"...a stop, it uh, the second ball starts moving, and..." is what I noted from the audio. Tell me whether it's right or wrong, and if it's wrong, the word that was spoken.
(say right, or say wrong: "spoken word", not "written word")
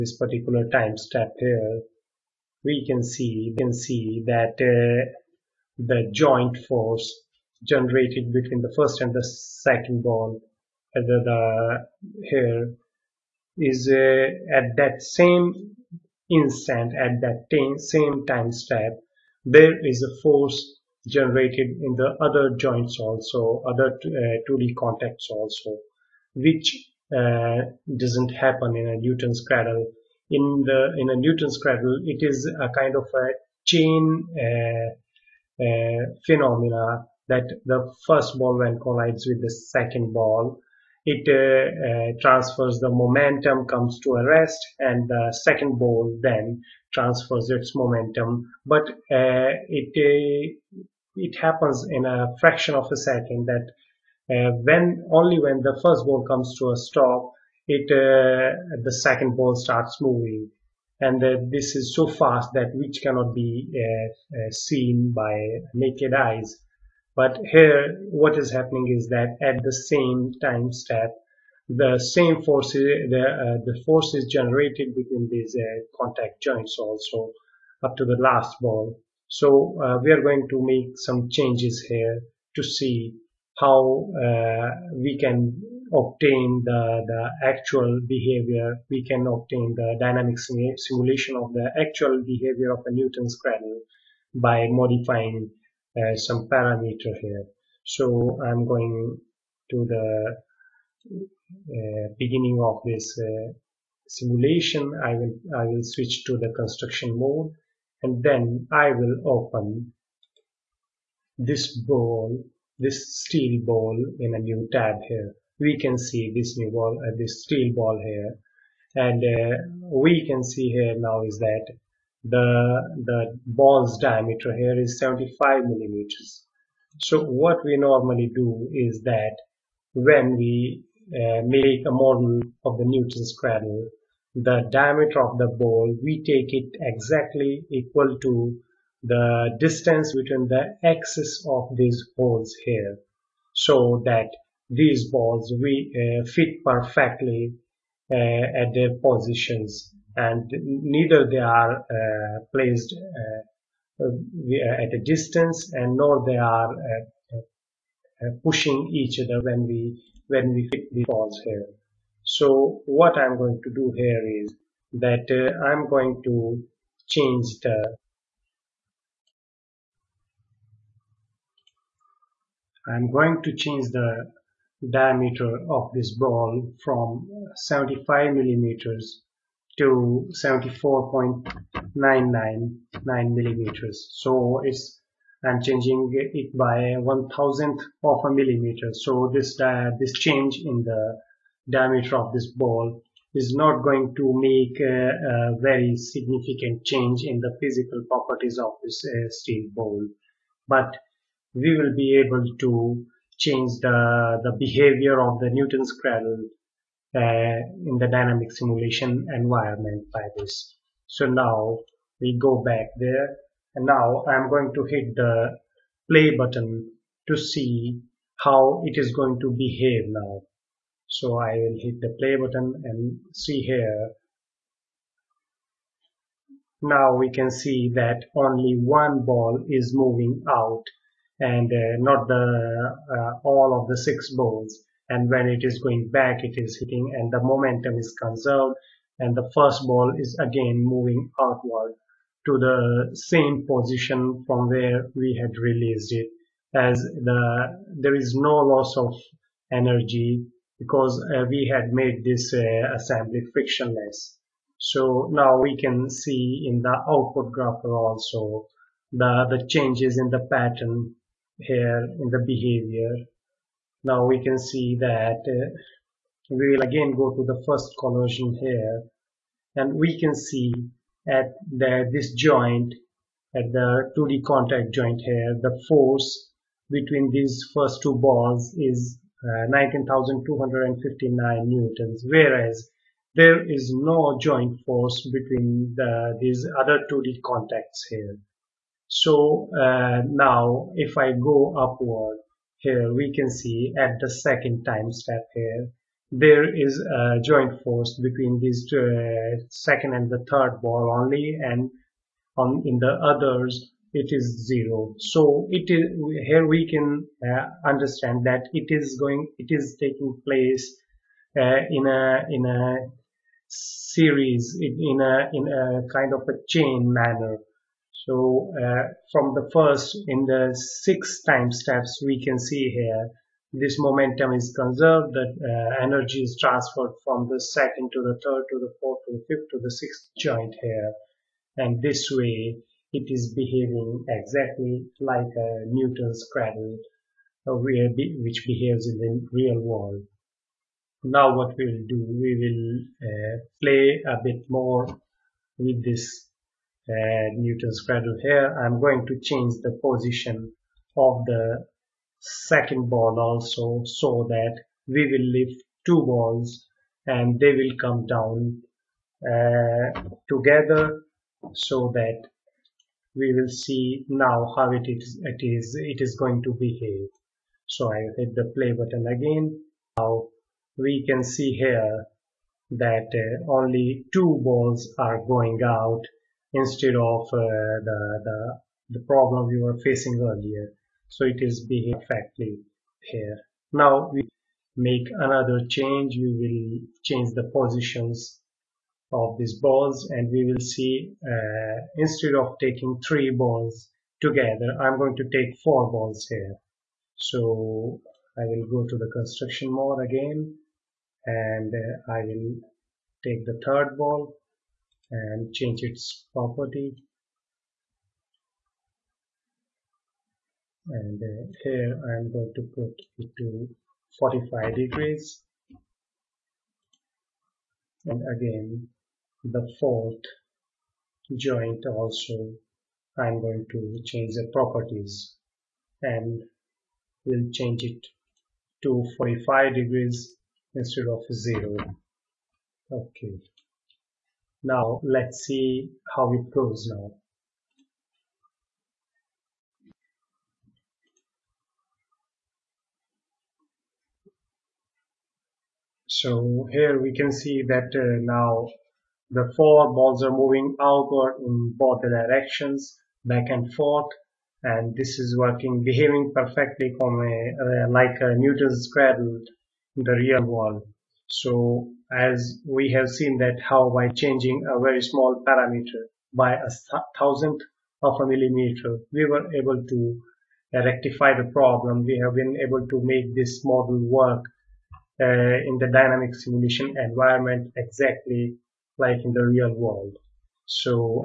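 right.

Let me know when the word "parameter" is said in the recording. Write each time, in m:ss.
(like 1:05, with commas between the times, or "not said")
1:36, 7:45.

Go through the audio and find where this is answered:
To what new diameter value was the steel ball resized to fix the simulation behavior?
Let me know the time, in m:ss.
3:00.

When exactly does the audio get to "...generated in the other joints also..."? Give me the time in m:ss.
0:21.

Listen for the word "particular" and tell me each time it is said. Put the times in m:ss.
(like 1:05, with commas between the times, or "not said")
0:00.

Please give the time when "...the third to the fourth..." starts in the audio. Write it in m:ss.
5:28.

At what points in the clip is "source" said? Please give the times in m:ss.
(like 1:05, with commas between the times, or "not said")
not said.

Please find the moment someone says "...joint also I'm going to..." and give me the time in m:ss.
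7:01.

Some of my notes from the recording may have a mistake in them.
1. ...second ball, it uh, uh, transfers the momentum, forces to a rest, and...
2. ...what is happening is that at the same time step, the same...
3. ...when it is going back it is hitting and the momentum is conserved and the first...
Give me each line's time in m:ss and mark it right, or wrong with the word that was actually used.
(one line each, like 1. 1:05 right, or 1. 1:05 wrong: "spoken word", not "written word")
1. 0:39 wrong: "comes", not "forces"
2. 1:08 right
3. 3:55 right.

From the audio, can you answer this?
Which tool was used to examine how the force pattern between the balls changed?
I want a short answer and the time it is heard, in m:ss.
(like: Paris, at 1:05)
Output grapher, at 4:17.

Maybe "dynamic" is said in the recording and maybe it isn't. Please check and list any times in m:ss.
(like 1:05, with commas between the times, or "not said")
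1:29, 3:28, 7:56.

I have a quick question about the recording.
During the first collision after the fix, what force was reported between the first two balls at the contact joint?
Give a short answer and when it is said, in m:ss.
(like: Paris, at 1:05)
19,259 newtons, at 4:39.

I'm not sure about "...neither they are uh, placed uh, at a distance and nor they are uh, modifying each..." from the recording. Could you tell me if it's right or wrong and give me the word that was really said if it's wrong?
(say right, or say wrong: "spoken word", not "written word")
wrong: "pushing", not "modifying".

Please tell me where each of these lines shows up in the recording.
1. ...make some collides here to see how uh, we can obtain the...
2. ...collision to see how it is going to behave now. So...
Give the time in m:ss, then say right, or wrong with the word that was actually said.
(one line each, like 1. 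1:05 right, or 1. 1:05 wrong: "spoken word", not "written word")
1. 1:20 wrong: "changes", not "collides"
2. 3:36 wrong: "button", not "collision".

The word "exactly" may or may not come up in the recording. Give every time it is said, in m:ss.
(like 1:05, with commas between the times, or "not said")
2:16, 5:34, 7:57.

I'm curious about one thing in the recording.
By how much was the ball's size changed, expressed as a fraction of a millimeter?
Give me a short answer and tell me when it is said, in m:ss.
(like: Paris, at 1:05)
One thousandth of a millimeter, at 3:06.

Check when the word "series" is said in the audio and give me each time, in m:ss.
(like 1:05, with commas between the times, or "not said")
5:13.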